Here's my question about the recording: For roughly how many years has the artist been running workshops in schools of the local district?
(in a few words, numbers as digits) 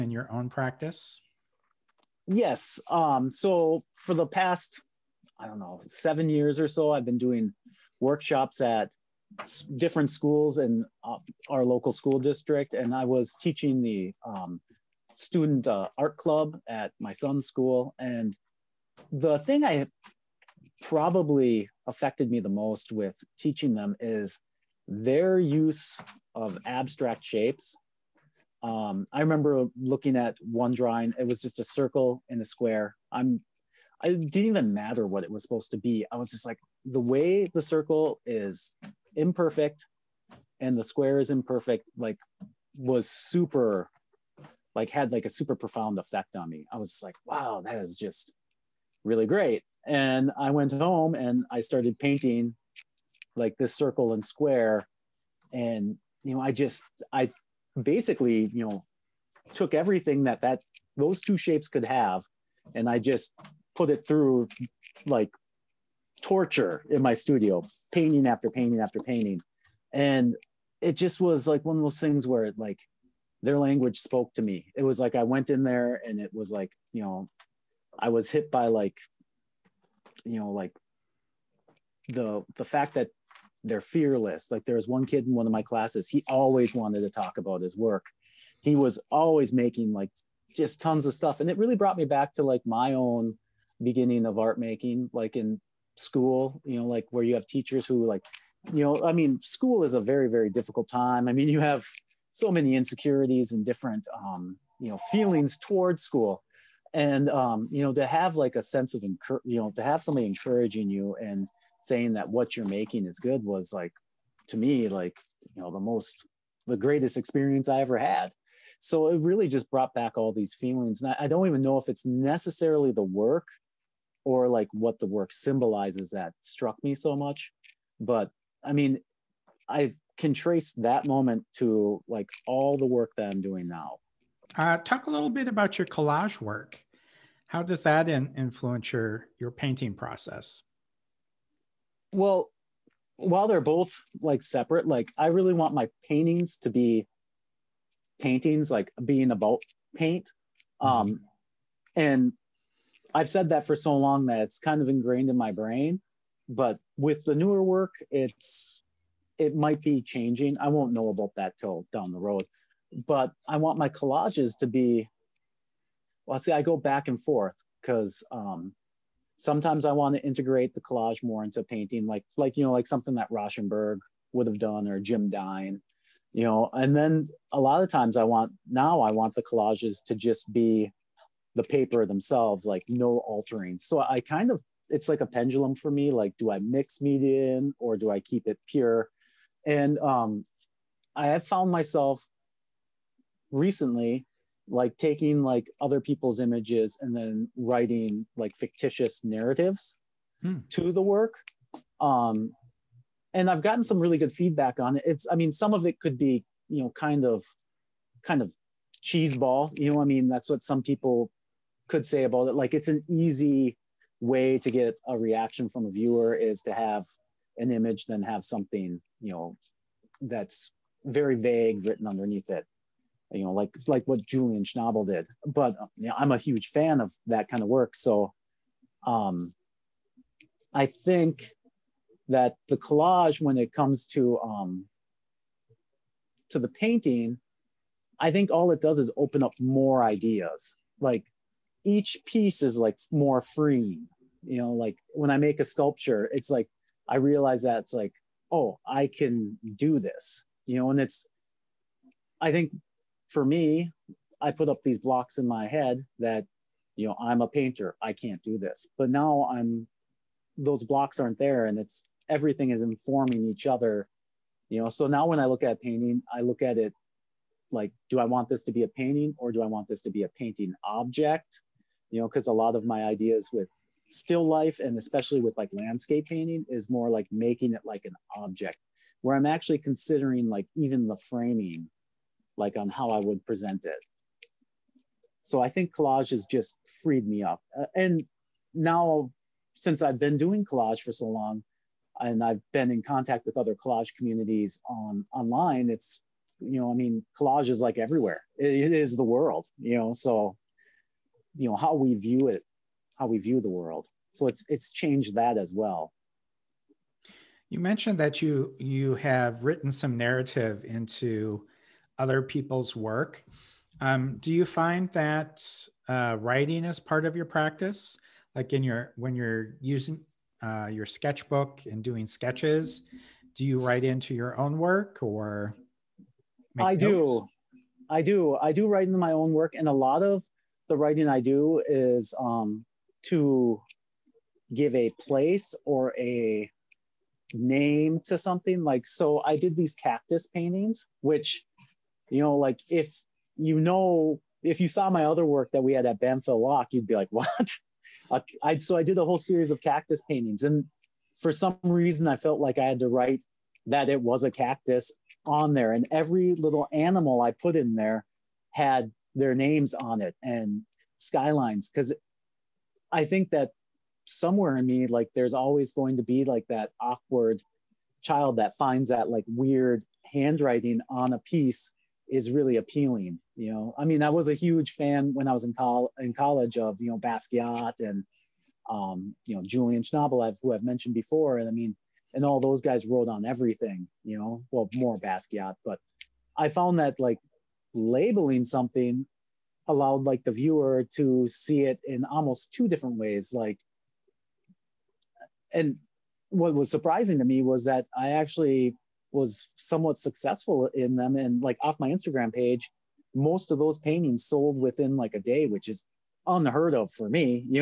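7.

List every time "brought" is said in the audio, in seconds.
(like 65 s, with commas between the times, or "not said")
91 s, 119 s.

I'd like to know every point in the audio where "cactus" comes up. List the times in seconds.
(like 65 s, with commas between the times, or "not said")
339 s, 349 s, 354 s.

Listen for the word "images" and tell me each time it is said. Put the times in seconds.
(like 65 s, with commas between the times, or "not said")
196 s, 217 s.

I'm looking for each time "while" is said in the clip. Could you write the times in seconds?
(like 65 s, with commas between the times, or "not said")
143 s.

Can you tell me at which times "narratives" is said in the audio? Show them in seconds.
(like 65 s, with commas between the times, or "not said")
199 s, 310 s.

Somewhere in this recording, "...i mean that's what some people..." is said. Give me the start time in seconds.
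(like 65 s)
210 s.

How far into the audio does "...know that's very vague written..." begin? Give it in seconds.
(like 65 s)
219 s.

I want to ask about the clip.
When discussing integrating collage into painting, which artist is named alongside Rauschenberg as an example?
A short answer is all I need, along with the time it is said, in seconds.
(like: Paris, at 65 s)
Jim Dine, at 174 s.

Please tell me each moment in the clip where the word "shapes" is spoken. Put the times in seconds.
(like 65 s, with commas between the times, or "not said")
27 s, 61 s.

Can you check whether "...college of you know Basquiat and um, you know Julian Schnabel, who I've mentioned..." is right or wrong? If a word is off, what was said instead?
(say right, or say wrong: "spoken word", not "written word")
right.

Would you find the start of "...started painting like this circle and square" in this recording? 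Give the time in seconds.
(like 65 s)
51 s.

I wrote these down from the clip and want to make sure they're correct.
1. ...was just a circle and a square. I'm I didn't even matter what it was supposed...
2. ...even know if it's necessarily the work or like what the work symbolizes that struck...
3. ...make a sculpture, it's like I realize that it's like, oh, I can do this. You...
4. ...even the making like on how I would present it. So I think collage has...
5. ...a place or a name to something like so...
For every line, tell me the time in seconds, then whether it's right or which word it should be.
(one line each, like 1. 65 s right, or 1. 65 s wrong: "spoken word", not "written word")
1. 31 s right
2. 121 s right
3. 245 s right
4. 280 s wrong: "framing", not "making"
5. 334 s right.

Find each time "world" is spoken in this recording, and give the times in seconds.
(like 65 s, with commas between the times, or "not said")
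299 s, 303 s.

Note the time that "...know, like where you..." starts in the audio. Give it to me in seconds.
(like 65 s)
96 s.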